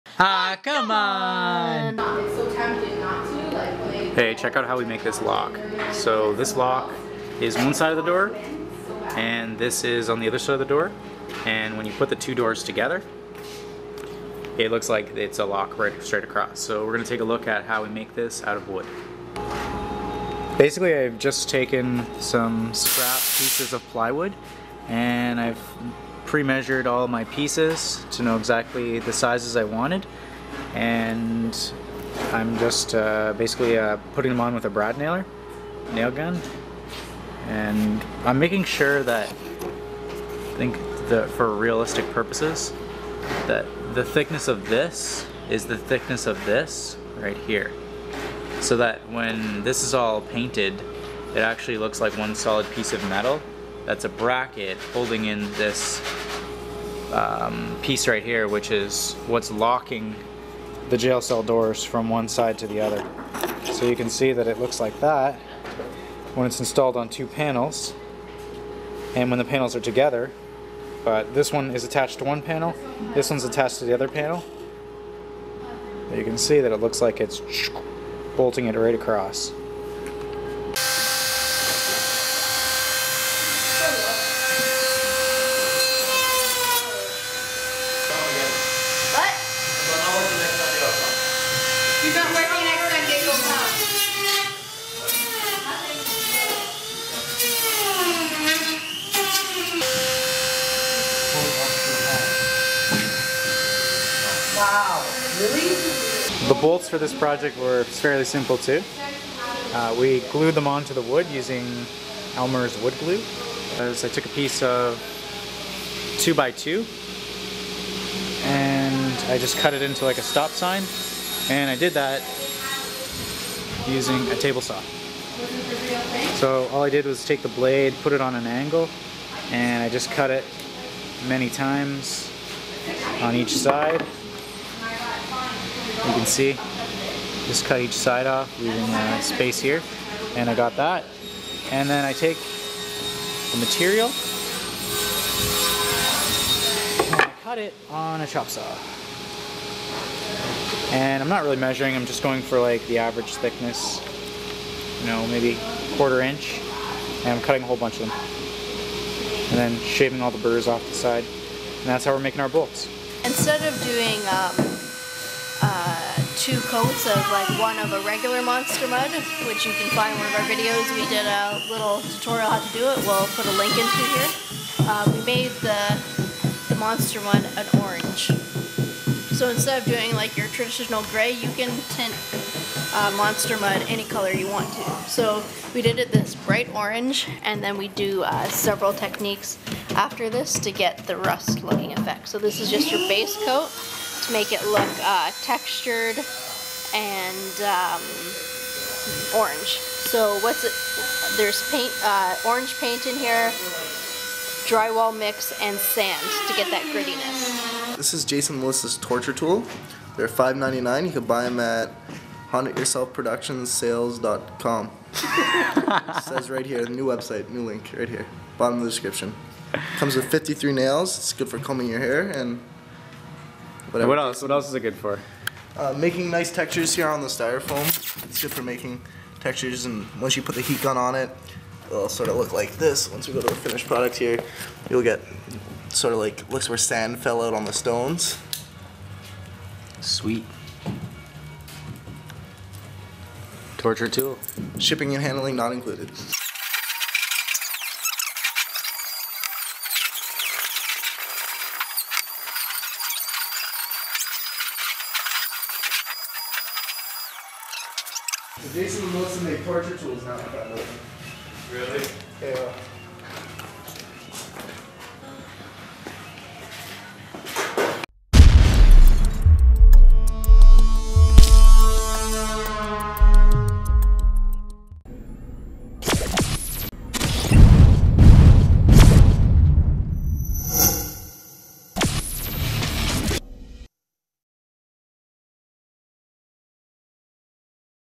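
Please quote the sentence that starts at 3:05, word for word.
So we did it this bright orange, and then we do uh, several techniques after this to get the rust looking effect.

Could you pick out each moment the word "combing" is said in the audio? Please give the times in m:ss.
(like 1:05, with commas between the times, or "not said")
3:41.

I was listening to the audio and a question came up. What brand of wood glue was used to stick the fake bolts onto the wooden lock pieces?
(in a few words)
Elmer's.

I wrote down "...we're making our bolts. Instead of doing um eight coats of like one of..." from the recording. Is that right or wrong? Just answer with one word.
wrong.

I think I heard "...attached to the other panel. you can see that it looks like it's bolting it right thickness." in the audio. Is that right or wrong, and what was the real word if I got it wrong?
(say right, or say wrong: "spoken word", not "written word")
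wrong: "across", not "thickness".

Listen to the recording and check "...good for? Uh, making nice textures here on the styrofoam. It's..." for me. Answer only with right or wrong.
right.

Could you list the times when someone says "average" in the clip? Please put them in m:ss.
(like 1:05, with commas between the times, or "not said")
2:32.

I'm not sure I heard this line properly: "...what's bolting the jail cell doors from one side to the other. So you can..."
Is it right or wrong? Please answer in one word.
wrong.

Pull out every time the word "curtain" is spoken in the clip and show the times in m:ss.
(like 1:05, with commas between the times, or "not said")
not said.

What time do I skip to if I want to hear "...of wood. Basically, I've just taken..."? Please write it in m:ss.
0:18.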